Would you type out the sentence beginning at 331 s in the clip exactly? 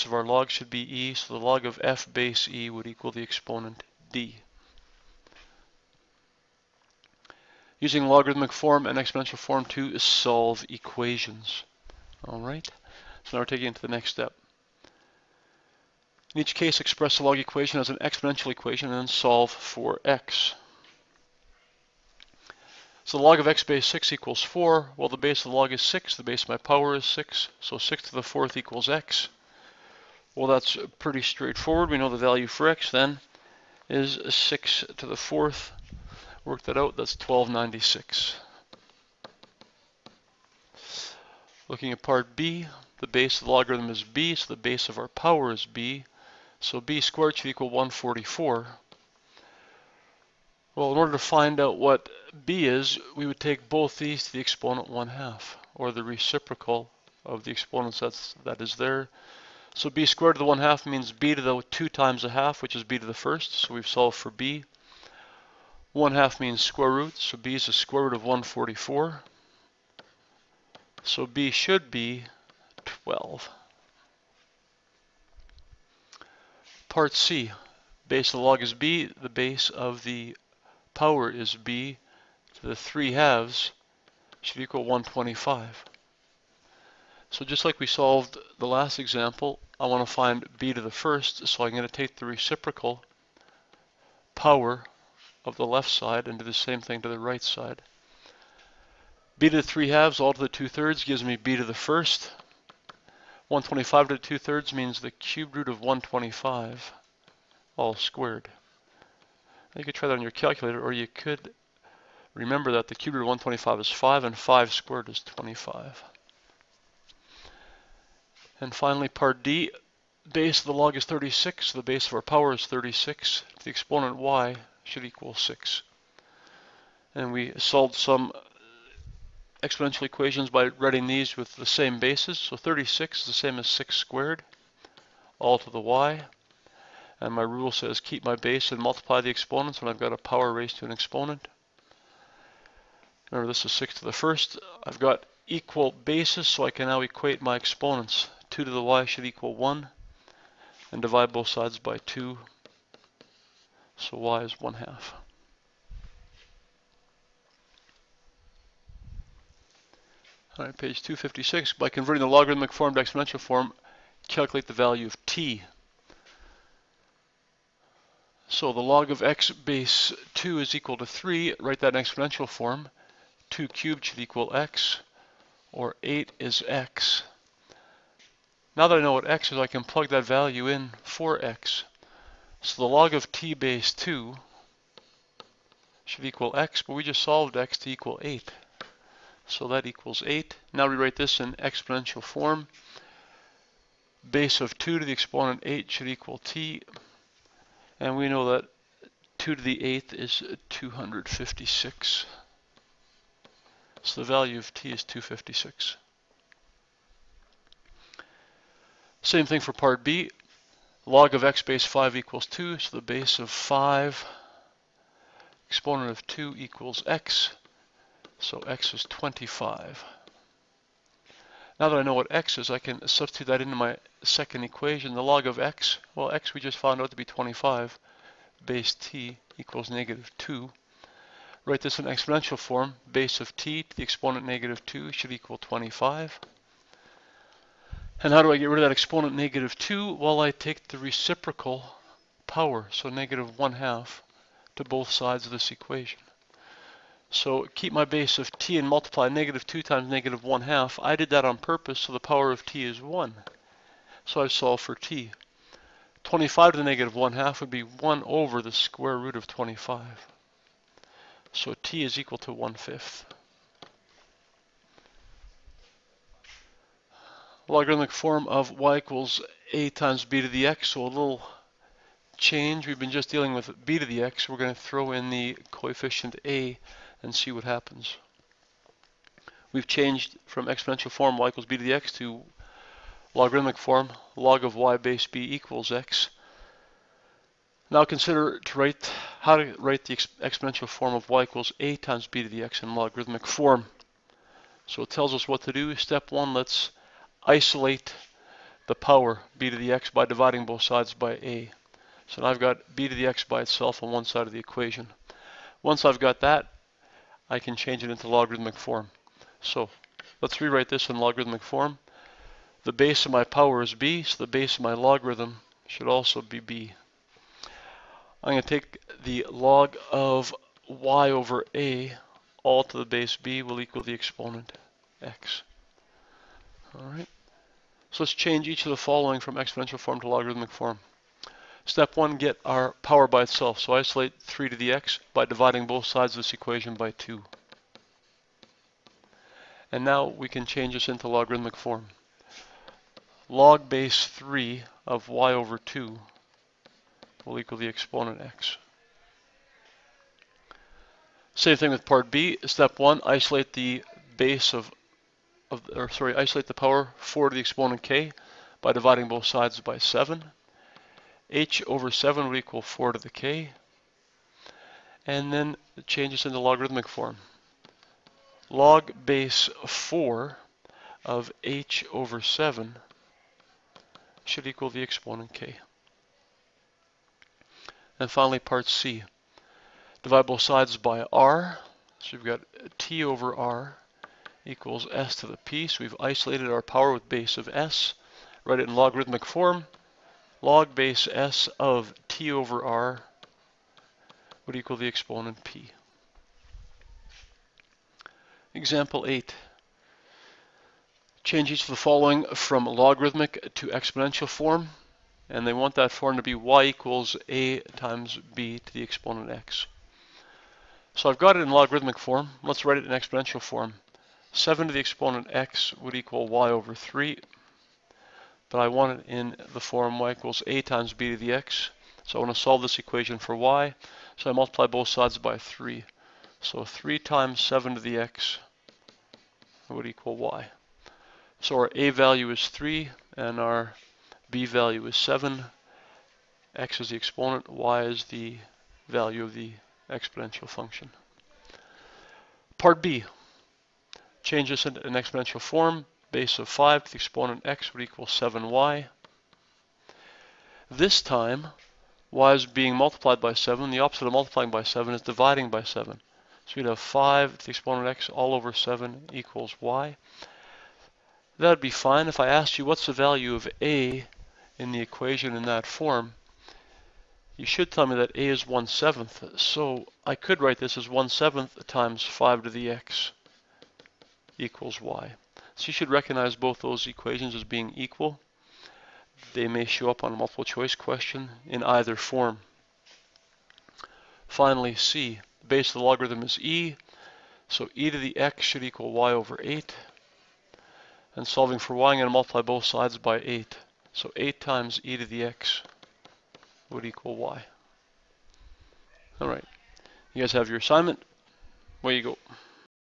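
Step one, get our power by itself.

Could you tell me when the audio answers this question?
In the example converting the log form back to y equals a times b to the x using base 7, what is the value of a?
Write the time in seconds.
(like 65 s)
431 s.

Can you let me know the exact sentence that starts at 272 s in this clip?
We've been just dealing with b to the x.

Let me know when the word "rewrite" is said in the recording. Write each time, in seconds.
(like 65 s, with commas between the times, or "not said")
190 s, 310 s.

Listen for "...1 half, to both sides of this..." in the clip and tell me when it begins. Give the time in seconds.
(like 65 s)
243 s.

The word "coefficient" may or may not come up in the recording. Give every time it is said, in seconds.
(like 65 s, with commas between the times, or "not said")
275 s.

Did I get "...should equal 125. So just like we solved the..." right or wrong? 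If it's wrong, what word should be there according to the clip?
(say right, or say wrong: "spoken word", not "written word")
right.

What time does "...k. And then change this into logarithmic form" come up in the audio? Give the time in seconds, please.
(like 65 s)
363 s.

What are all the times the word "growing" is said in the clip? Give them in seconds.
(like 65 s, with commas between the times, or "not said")
not said.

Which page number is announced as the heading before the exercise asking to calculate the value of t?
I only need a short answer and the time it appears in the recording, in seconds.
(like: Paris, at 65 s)
256, at 160 s.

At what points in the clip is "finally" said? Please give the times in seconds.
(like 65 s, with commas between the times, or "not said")
118 s, 378 s, 484 s.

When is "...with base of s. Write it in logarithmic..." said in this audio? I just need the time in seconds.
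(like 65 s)
387 s.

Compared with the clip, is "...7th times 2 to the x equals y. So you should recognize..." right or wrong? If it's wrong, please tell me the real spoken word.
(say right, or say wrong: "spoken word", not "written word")
wrong: "5", not "2".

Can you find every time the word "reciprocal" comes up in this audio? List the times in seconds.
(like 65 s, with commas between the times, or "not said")
56 s, 92 s, 240 s.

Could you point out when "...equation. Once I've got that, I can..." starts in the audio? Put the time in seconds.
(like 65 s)
304 s.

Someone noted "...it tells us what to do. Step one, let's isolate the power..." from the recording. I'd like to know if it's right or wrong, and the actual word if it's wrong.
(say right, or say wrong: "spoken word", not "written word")
right.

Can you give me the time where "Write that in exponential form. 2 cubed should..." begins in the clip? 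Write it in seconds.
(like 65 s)
171 s.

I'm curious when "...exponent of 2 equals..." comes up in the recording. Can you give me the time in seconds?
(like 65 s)
215 s.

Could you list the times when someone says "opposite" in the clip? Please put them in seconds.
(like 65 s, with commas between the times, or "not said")
453 s.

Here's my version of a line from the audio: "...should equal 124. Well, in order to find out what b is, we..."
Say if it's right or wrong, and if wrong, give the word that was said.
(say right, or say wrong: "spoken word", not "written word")
wrong: "144", not "124".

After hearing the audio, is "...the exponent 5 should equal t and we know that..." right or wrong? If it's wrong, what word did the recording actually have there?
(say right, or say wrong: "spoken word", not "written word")
wrong: "8", not "5".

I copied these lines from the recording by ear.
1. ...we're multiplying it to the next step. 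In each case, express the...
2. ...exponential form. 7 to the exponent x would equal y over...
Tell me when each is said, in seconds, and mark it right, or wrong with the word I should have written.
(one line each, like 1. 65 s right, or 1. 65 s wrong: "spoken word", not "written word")
1. 13 s wrong: "taking", not "multiplying"
2. 413 s right.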